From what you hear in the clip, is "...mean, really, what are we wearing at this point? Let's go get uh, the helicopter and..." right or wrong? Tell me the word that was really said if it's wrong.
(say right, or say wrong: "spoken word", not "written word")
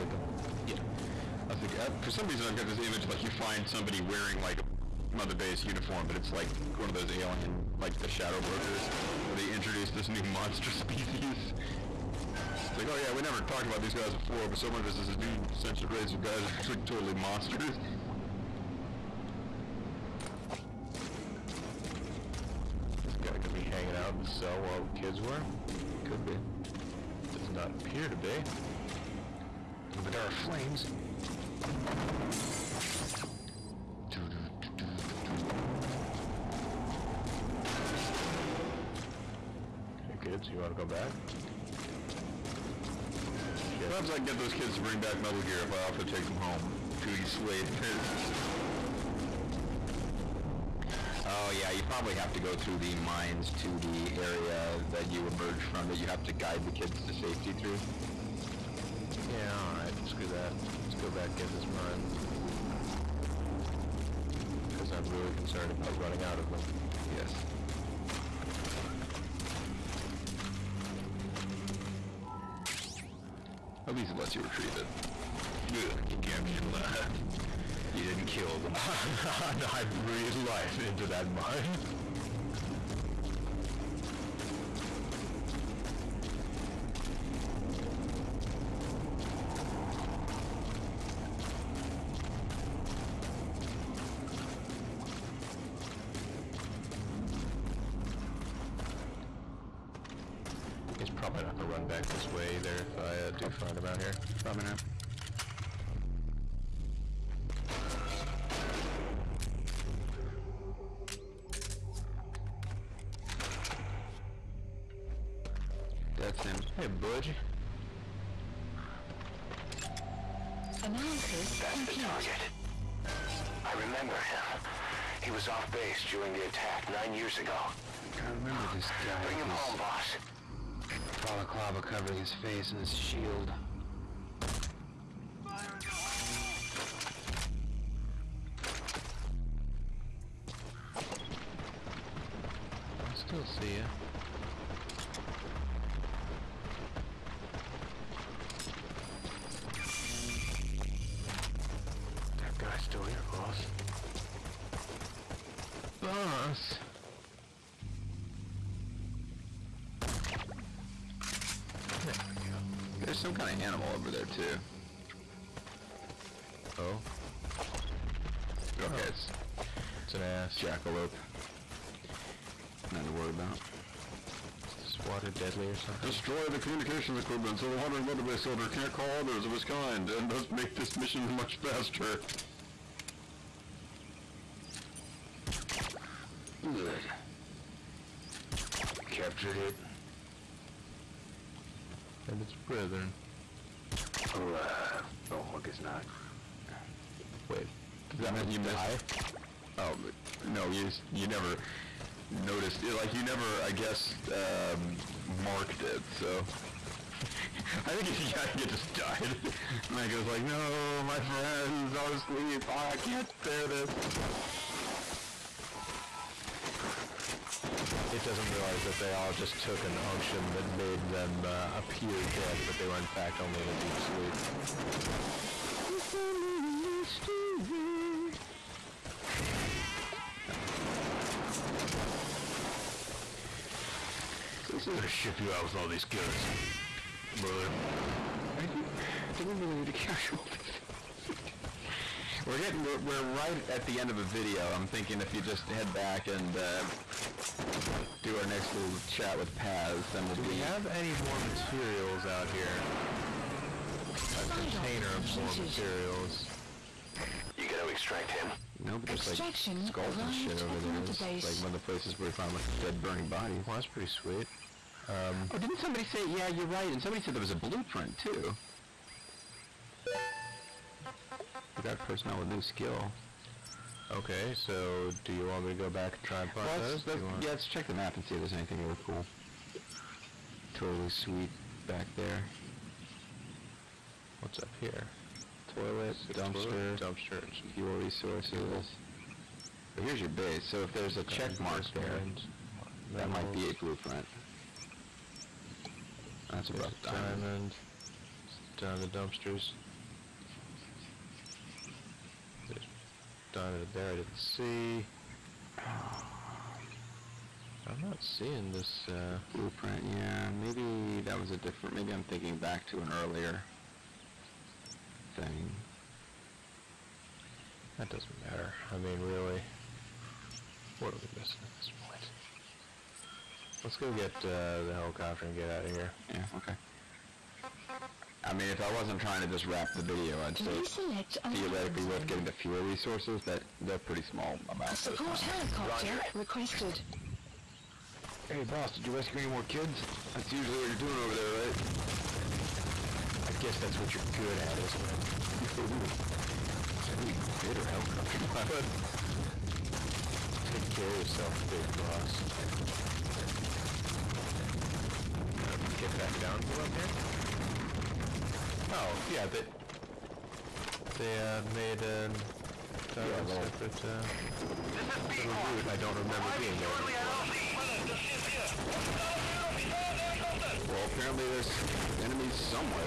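wrong: "missing", not "wearing".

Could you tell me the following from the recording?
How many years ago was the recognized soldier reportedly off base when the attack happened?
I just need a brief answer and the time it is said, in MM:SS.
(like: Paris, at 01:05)
9, at 02:06.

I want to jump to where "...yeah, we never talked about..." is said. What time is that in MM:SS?
00:12.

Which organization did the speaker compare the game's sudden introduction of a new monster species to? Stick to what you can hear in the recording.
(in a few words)
Shadow Brokers.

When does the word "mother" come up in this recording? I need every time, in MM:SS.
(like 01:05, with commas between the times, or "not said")
00:05, 02:58.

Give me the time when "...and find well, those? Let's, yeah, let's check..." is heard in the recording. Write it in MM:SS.
04:36.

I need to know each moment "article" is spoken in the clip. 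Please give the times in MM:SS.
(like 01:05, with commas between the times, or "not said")
not said.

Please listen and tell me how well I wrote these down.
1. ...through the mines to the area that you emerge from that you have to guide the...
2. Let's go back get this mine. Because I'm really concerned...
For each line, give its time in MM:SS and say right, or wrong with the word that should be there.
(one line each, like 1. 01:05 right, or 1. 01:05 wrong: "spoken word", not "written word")
1. 00:52 right
2. 01:00 right.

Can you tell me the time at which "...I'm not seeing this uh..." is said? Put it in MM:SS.
05:07.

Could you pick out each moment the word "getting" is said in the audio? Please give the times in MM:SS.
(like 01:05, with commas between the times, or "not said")
04:02, 05:32.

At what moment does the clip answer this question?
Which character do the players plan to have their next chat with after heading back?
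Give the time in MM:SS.
04:09.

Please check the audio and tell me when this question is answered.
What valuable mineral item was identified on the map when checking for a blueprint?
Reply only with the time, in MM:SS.
04:56.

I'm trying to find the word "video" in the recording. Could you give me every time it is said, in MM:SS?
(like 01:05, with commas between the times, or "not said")
04:04, 05:30.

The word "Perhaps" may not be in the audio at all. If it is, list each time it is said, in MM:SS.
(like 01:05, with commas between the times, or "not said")
00:43.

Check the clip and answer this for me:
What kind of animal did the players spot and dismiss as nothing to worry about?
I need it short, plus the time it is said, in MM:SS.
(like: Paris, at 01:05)
Jackalope, at 02:50.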